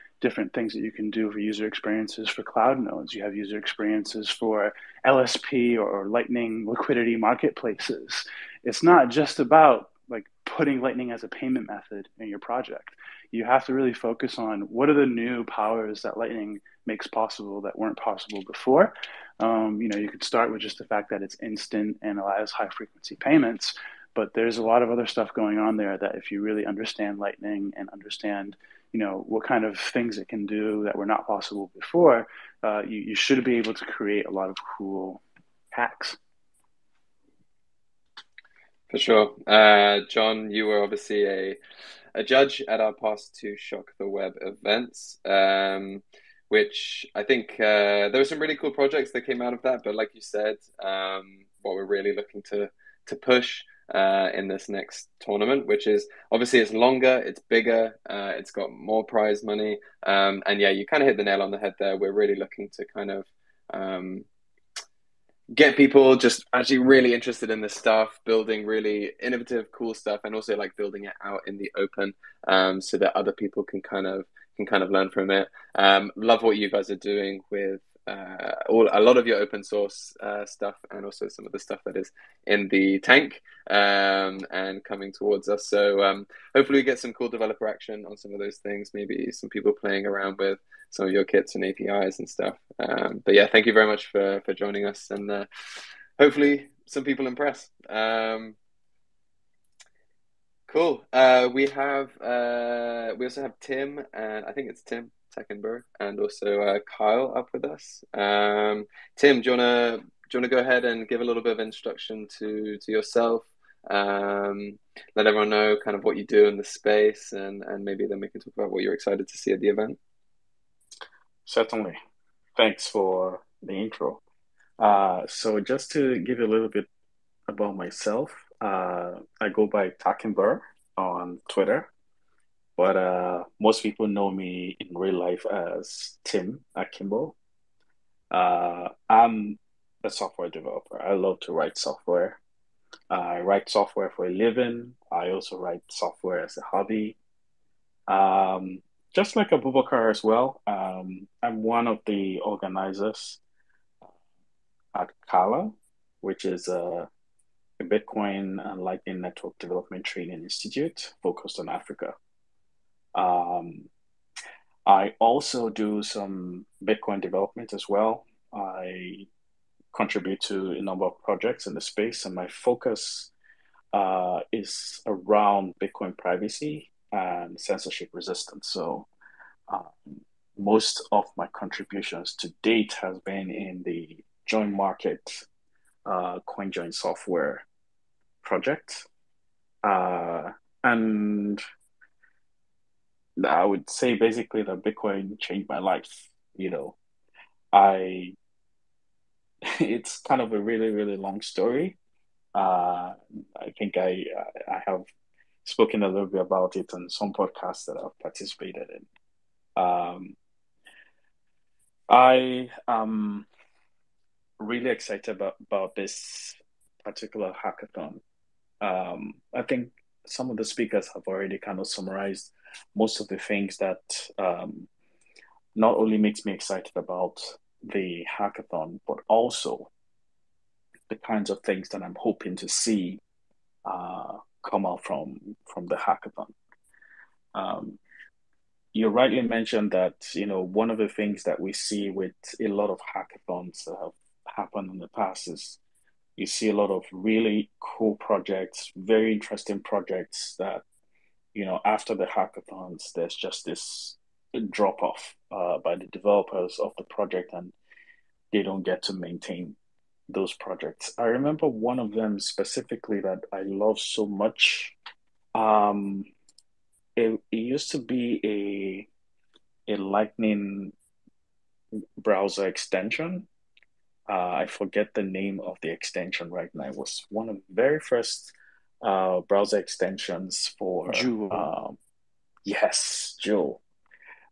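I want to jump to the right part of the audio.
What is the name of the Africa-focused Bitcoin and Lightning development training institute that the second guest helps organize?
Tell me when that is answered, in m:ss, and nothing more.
2:35.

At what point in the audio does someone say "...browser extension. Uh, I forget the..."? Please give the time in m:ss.
4:32.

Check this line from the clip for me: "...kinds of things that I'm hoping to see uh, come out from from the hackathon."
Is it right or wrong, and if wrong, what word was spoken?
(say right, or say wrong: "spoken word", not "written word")
right.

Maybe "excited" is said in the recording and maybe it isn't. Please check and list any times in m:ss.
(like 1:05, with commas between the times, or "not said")
1:58, 3:34, 3:46.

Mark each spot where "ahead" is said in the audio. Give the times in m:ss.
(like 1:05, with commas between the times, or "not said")
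1:50.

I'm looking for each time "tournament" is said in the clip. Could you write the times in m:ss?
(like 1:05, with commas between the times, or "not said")
0:55.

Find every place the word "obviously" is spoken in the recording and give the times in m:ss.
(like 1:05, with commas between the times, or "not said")
0:40, 0:56.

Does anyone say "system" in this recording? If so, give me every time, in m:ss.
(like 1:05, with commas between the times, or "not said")
not said.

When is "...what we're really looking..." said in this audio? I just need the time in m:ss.
0:51.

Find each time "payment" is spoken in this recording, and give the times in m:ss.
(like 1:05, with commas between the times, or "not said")
0:11, 0:23.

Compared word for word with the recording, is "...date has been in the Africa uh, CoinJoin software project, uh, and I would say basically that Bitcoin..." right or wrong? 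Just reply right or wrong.
wrong.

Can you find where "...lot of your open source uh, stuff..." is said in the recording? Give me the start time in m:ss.
1:19.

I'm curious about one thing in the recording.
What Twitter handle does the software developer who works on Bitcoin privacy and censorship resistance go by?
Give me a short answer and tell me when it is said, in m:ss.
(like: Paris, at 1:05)
takinbo, at 2:09.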